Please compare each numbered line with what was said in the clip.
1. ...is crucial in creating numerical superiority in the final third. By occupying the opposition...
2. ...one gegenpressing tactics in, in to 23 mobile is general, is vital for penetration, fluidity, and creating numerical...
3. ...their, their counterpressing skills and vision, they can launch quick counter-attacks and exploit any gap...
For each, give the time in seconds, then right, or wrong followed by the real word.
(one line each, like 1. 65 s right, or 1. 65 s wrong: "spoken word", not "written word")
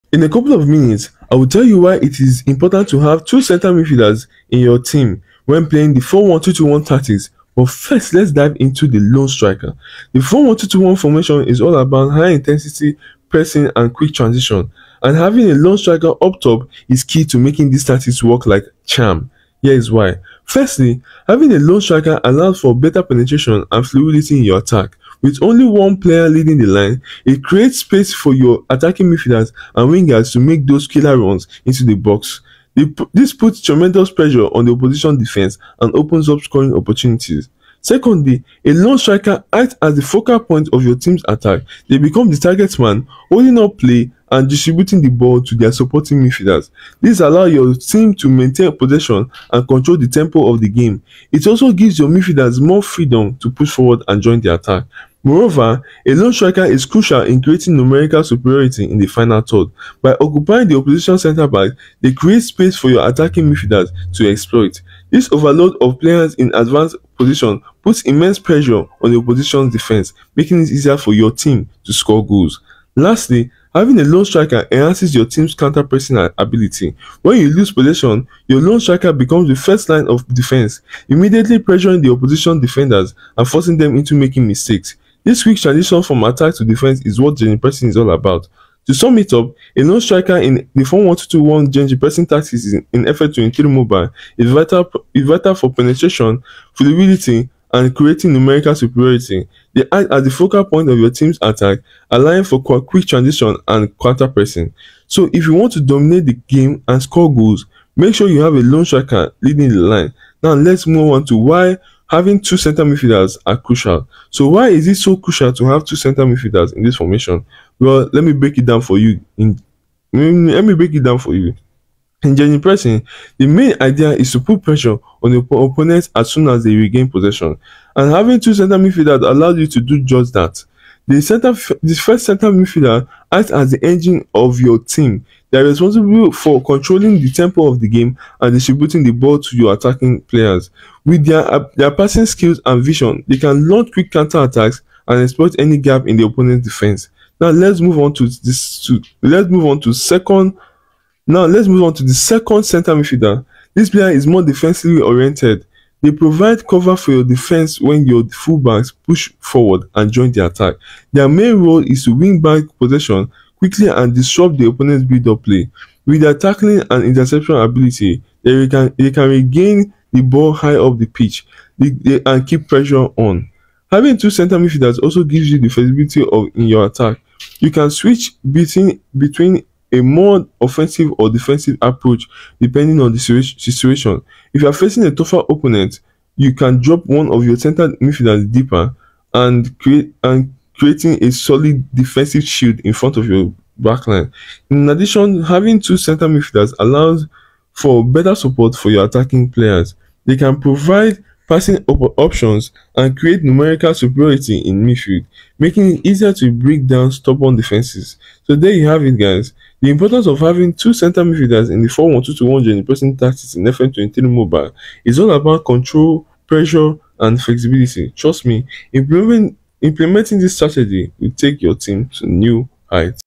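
1. 56 s right
2. 91 s wrong: "vital", not "general"
3. 141 s wrong: "passing", not "counterpressing".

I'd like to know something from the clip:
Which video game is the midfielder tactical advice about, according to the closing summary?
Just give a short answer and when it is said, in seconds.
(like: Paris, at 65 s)
FM23 mobile, at 213 s.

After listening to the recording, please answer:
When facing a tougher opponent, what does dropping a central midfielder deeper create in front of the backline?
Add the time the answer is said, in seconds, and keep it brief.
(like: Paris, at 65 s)
Solid defensive shield, at 191 s.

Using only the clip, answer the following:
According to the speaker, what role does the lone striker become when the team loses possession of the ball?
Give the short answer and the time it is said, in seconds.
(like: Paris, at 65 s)
First line of defense, at 79 s.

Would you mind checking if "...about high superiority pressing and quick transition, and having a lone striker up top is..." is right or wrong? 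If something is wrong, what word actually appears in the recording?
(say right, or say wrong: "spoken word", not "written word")
wrong: "intensity", not "superiority".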